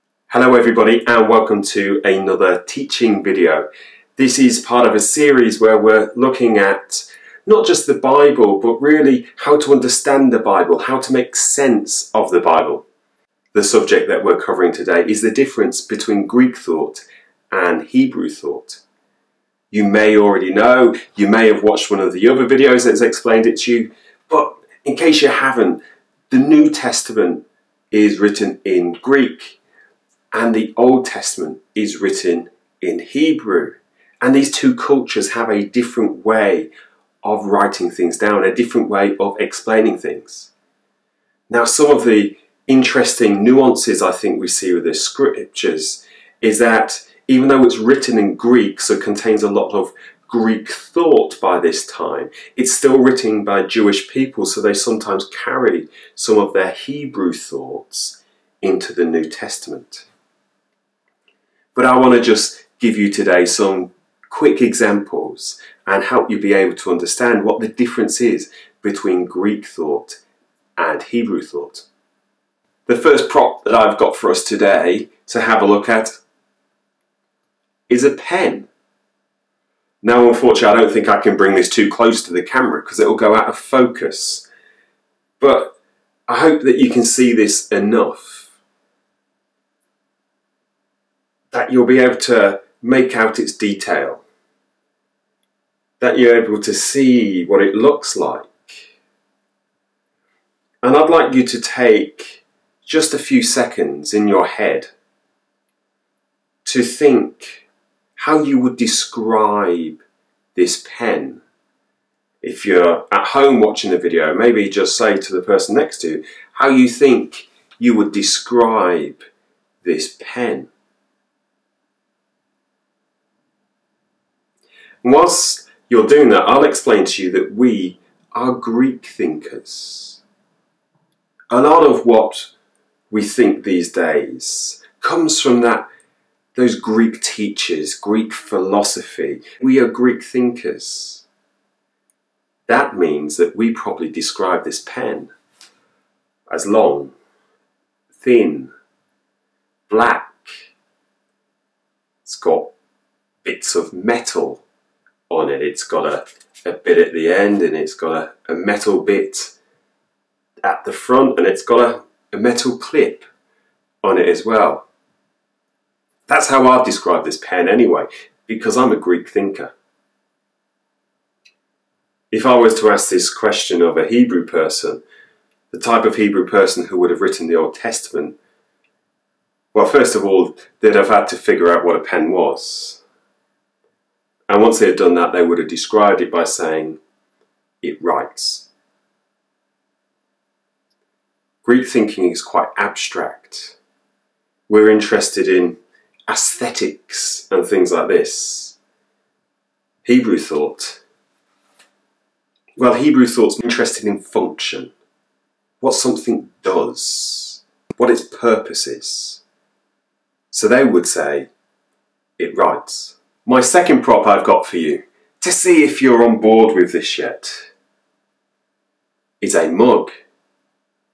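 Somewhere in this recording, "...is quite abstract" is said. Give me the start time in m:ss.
3:12.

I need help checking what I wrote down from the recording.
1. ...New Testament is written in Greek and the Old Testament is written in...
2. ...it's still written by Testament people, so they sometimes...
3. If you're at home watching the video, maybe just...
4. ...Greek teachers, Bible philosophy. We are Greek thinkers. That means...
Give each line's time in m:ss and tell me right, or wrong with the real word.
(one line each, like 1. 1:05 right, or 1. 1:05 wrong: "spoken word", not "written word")
1. 0:26 right
2. 0:52 wrong: "Jewish", not "Testament"
3. 1:52 right
4. 2:16 wrong: "Greek", not "Bible".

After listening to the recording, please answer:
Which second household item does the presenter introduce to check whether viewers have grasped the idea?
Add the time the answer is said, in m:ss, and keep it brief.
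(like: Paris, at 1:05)
A mug, at 3:39.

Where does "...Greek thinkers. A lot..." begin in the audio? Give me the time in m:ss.
2:08.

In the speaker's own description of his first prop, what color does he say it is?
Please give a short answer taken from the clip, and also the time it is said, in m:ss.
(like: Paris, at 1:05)
Black, at 2:29.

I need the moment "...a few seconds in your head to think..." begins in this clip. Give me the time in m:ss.
1:43.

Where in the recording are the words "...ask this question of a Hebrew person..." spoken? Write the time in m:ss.
2:52.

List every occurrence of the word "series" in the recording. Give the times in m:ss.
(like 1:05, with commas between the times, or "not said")
0:05.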